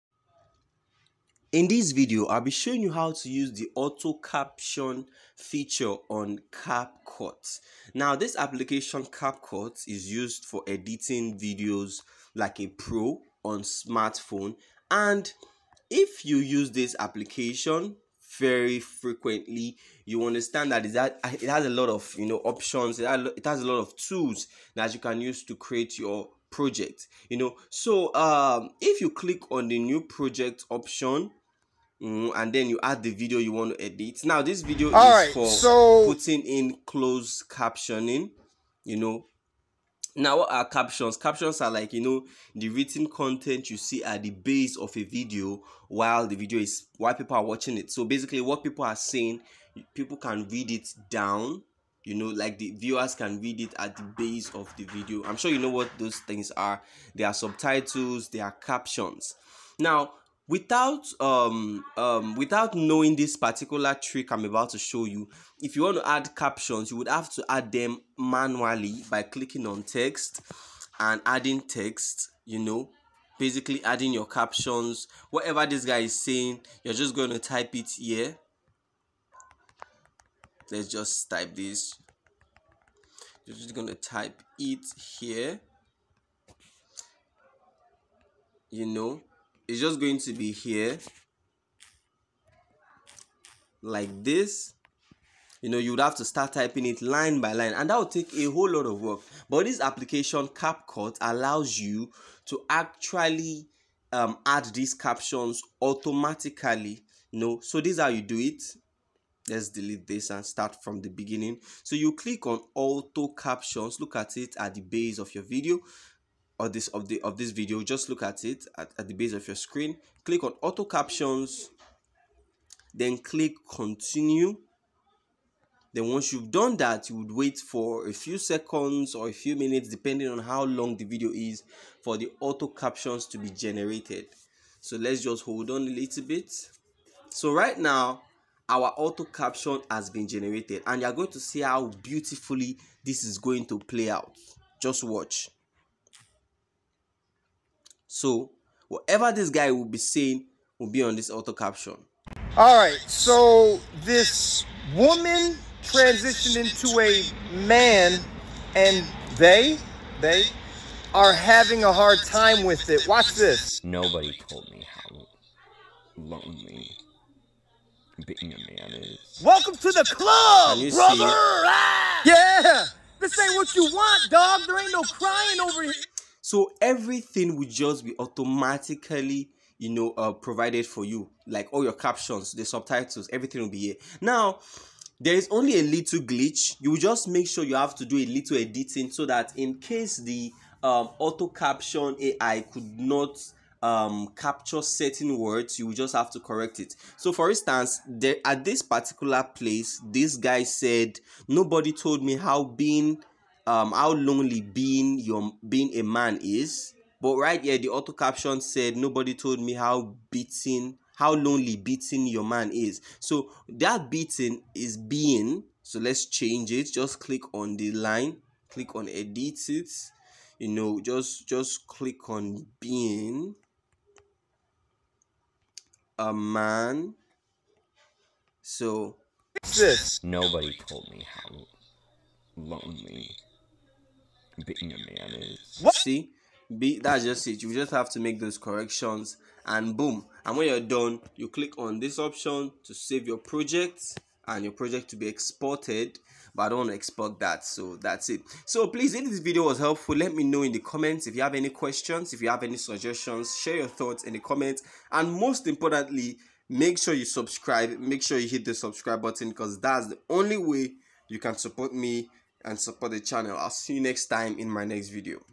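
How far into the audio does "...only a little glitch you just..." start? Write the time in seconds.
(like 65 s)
185 s.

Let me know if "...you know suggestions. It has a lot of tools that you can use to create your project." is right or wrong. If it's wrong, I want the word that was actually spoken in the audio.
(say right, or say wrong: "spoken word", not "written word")
wrong: "options", not "suggestions".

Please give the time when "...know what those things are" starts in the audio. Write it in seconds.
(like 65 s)
55 s.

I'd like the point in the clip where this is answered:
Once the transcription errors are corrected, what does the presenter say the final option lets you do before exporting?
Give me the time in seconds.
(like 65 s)
242 s.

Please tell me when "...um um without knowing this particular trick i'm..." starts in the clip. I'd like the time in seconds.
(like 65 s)
61 s.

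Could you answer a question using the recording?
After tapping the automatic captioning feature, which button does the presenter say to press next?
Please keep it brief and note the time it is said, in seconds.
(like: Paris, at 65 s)
Continue, at 123 s.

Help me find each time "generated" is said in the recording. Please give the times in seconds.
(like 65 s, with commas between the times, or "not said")
133 s, 140 s.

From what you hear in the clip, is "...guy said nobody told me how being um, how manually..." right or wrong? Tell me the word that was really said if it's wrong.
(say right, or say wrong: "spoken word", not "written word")
wrong: "lonely", not "manually".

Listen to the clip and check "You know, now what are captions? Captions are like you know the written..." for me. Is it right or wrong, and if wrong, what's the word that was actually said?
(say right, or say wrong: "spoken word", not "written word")
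right.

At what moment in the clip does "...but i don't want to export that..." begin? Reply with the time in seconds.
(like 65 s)
246 s.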